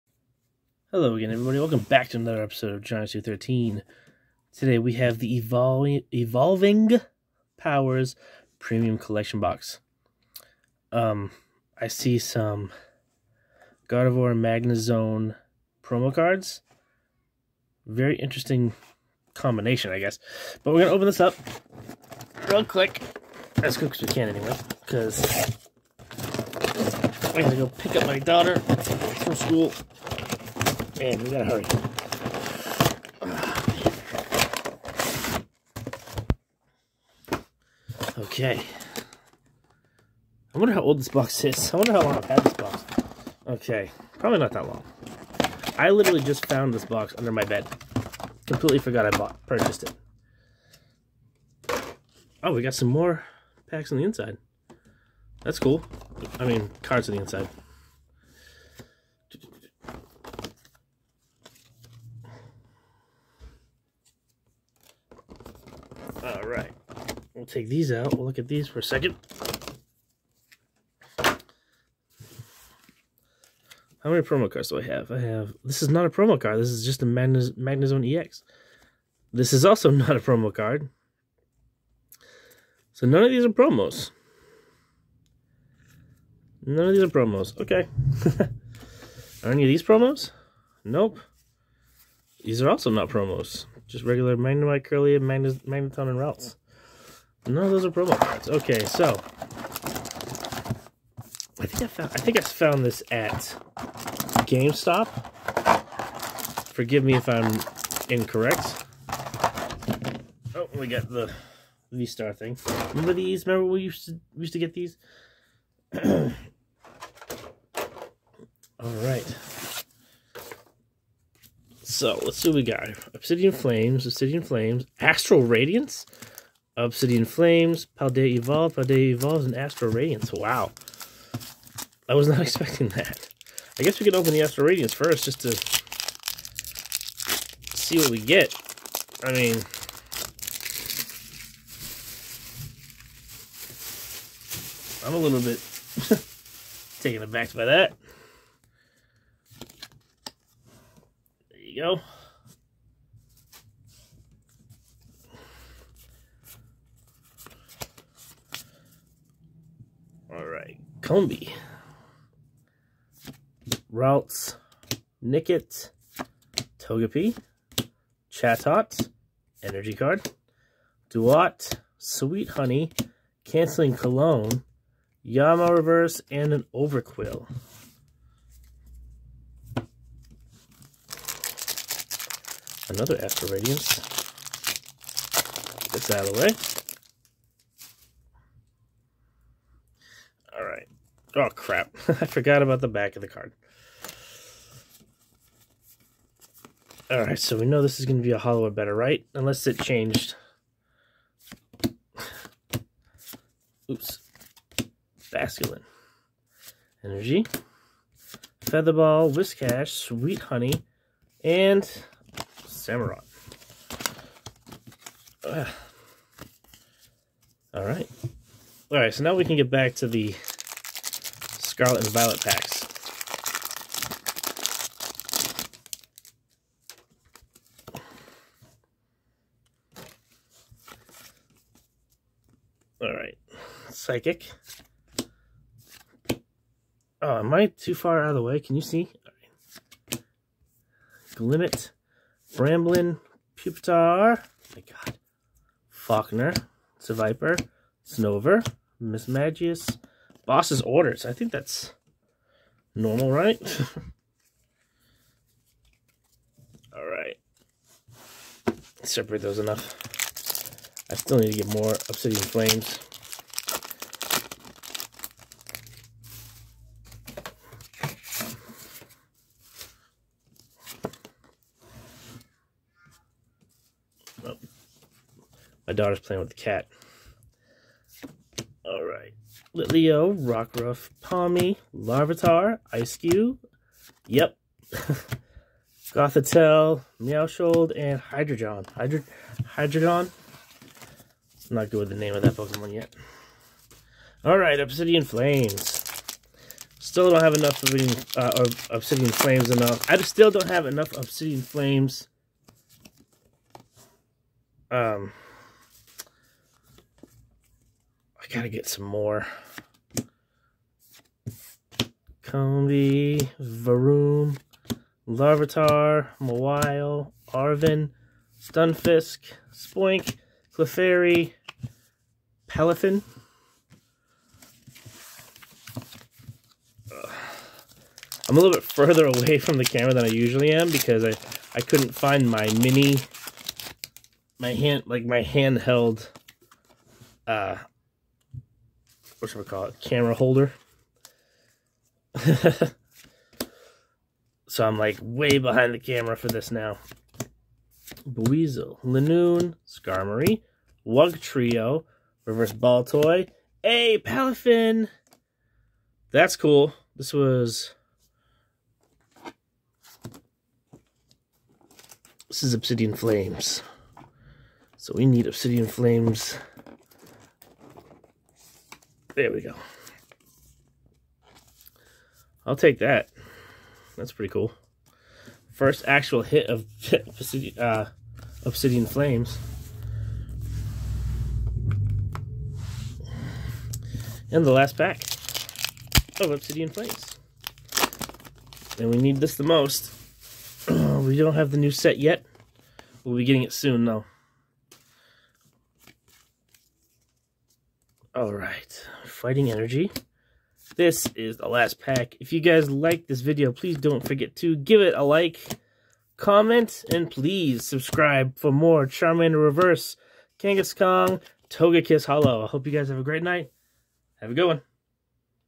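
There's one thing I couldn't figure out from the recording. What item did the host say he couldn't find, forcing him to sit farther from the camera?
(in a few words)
camera holder.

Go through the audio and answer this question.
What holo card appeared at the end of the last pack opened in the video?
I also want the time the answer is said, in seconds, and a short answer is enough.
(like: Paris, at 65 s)
Togekiss, at 411 s.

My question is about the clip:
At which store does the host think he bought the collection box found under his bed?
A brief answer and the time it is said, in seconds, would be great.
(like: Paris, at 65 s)
GameStop, at 104 s.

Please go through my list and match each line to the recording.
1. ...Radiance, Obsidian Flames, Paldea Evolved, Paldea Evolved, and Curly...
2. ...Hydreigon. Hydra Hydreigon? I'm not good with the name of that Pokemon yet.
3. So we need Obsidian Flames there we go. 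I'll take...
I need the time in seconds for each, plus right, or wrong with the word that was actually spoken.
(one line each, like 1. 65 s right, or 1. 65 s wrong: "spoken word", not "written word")
1. 125 s wrong: "Astral", not "Curly"
2. 288 s right
3. 364 s right.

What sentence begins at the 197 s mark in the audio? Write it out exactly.
Alright, so we know this is going to be a holo or better, right?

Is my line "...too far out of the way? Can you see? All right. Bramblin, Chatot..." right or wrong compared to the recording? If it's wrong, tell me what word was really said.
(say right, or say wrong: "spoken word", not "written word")
wrong: "Pupitar", not "Chatot".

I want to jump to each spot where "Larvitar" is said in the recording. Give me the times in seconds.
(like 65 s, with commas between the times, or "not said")
281 s, 315 s.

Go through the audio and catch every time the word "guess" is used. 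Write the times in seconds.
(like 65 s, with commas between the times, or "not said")
19 s, 133 s.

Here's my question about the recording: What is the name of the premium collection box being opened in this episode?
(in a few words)
Evolving Powers.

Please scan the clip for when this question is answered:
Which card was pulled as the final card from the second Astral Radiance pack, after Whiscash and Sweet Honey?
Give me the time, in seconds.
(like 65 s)
212 s.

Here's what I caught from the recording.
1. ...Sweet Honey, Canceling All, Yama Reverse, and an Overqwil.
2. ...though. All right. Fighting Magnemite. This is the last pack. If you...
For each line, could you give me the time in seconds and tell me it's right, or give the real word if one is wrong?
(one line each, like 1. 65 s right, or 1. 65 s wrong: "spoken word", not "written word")
1. 171 s wrong: "Cologne", not "All"
2. 394 s wrong: "Energy", not "Magnemite".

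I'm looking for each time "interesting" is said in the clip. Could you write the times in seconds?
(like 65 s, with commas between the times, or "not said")
18 s.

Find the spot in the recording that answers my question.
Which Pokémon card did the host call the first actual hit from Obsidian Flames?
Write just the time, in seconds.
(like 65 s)
354 s.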